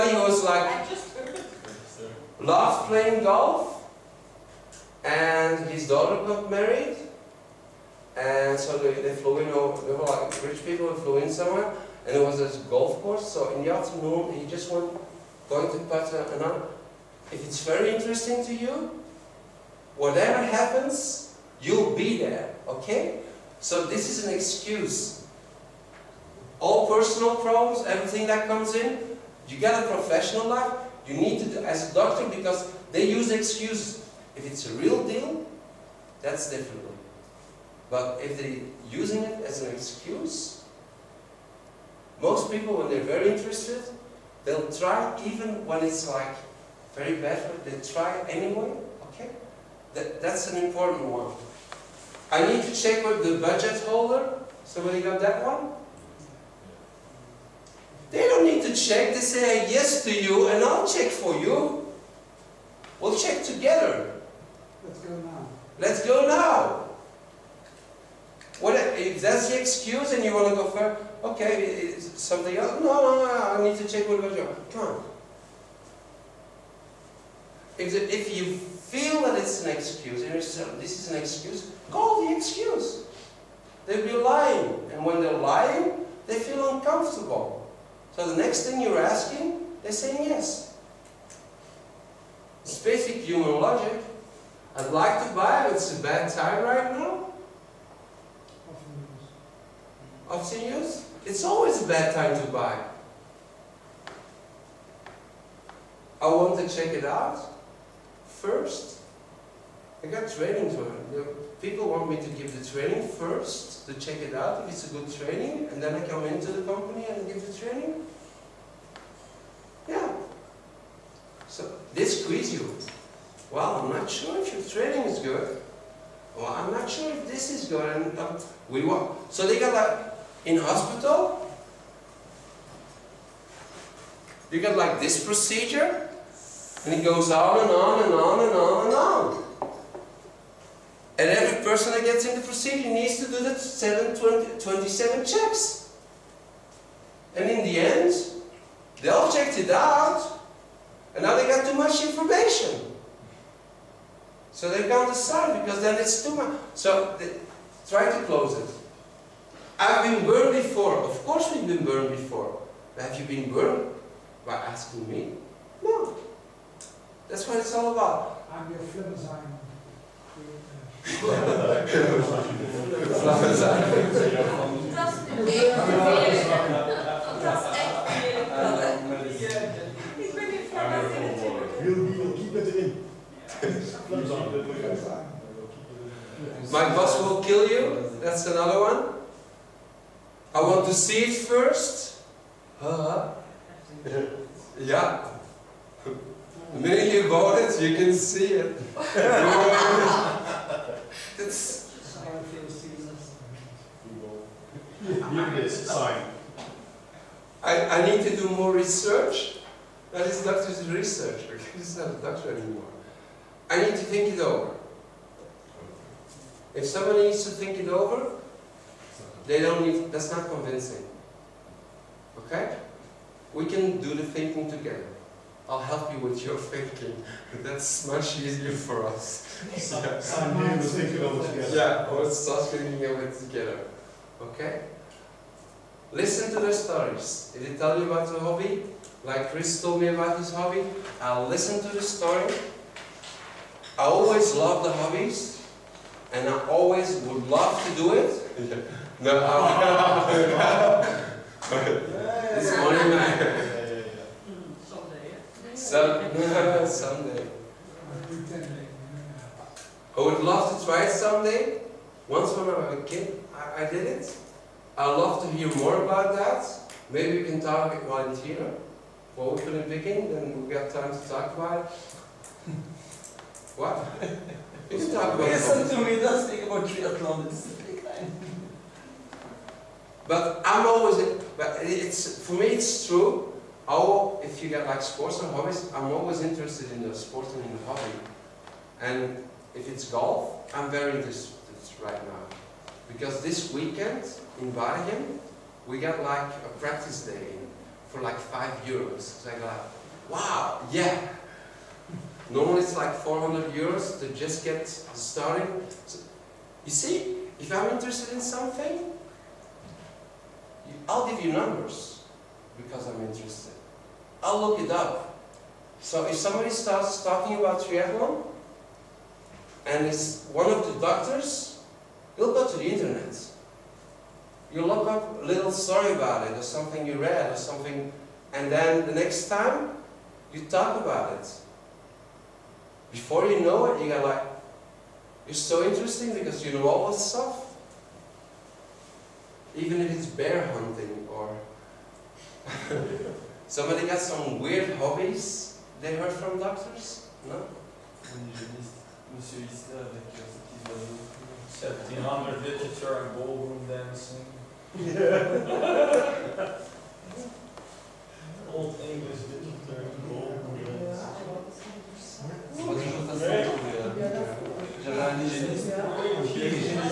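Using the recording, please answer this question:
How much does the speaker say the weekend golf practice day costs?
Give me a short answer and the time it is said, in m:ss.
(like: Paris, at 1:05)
5 euros, at 4:58.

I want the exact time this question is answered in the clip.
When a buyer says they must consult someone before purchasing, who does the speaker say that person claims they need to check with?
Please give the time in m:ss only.
0:53.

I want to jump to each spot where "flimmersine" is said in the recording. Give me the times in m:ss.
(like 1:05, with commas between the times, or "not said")
2:48.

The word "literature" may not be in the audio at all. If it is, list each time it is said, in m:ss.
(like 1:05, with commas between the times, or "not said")
5:52, 5:59.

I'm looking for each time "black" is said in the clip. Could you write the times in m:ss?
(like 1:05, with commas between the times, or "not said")
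not said.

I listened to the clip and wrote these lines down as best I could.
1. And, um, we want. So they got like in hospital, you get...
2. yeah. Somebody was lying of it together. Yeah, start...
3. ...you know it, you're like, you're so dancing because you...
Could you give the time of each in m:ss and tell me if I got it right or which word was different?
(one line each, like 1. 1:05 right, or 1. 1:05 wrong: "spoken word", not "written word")
1. 2:08 right
2. 3:49 wrong: "thinking", not "lying"
3. 5:33 wrong: "interesting", not "dancing".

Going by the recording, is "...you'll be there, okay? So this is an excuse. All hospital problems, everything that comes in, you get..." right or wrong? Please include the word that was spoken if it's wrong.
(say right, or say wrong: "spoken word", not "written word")
wrong: "personal", not "hospital".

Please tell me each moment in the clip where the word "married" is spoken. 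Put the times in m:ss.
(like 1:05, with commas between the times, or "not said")
0:06.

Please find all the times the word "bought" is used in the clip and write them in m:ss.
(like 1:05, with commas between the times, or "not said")
3:17.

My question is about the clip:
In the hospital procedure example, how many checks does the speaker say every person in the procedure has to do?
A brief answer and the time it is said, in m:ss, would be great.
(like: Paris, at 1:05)
7, 20, 27, at 2:23.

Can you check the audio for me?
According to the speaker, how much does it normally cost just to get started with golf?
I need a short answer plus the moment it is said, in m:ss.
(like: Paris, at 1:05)
400 euros, at 5:03.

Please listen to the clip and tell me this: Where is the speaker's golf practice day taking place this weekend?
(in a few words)
Bergen.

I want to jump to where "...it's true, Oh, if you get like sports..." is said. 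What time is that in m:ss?
4:42.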